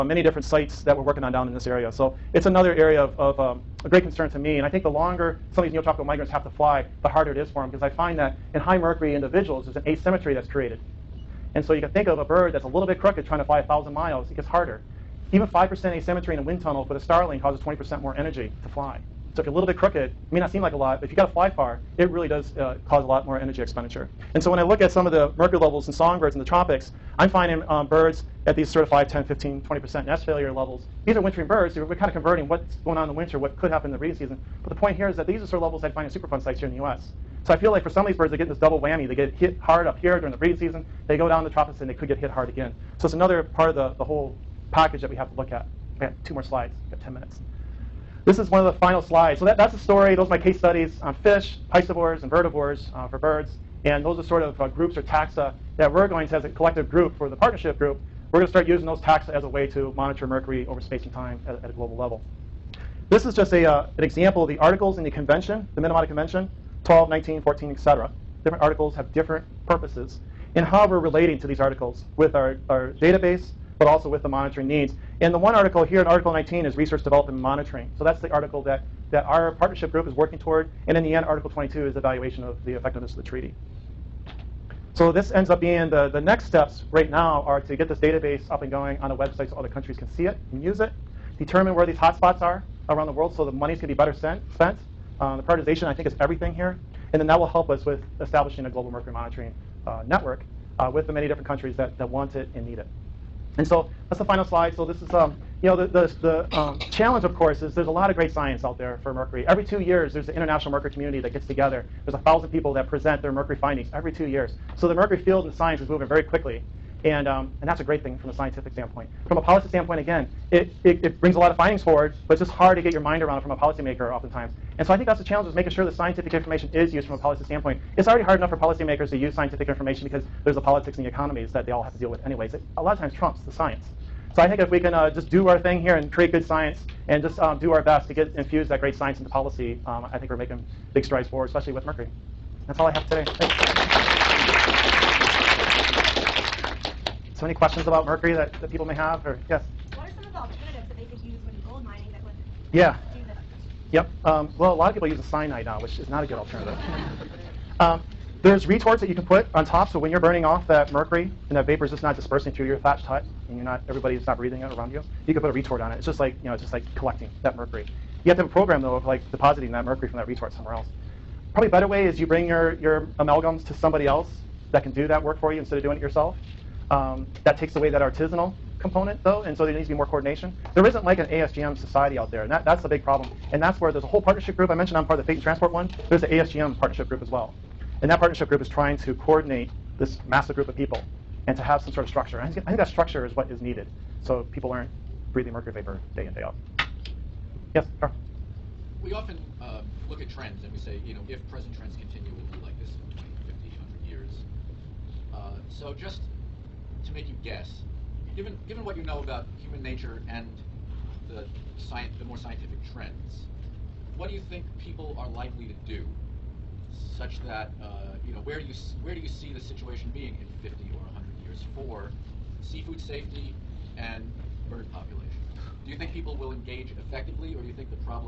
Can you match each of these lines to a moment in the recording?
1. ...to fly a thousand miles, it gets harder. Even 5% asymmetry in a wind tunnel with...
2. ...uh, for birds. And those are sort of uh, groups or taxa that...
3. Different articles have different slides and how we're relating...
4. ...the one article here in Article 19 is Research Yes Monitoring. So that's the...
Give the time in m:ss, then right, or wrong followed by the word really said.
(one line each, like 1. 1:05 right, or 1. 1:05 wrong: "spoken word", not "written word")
1. 0:13 right
2. 0:52 right
3. 1:08 wrong: "purposes", not "slides"
4. 1:15 wrong: "Development", not "Yes".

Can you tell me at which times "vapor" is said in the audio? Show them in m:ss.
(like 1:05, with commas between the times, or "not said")
2:41, 3:15.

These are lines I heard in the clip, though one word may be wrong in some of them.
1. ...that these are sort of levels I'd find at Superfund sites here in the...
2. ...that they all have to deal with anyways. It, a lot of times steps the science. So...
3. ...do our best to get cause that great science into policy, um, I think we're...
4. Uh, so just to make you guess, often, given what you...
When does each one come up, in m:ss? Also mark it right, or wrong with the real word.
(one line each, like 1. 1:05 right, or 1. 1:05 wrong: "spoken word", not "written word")
1. 0:35 right
2. 2:11 wrong: "trumps", not "steps"
3. 2:17 wrong: "infuse", not "cause"
4. 3:25 wrong: "given", not "often".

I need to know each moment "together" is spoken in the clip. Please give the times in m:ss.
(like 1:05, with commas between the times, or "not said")
1:51.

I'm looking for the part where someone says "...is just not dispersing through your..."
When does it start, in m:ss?
2:41.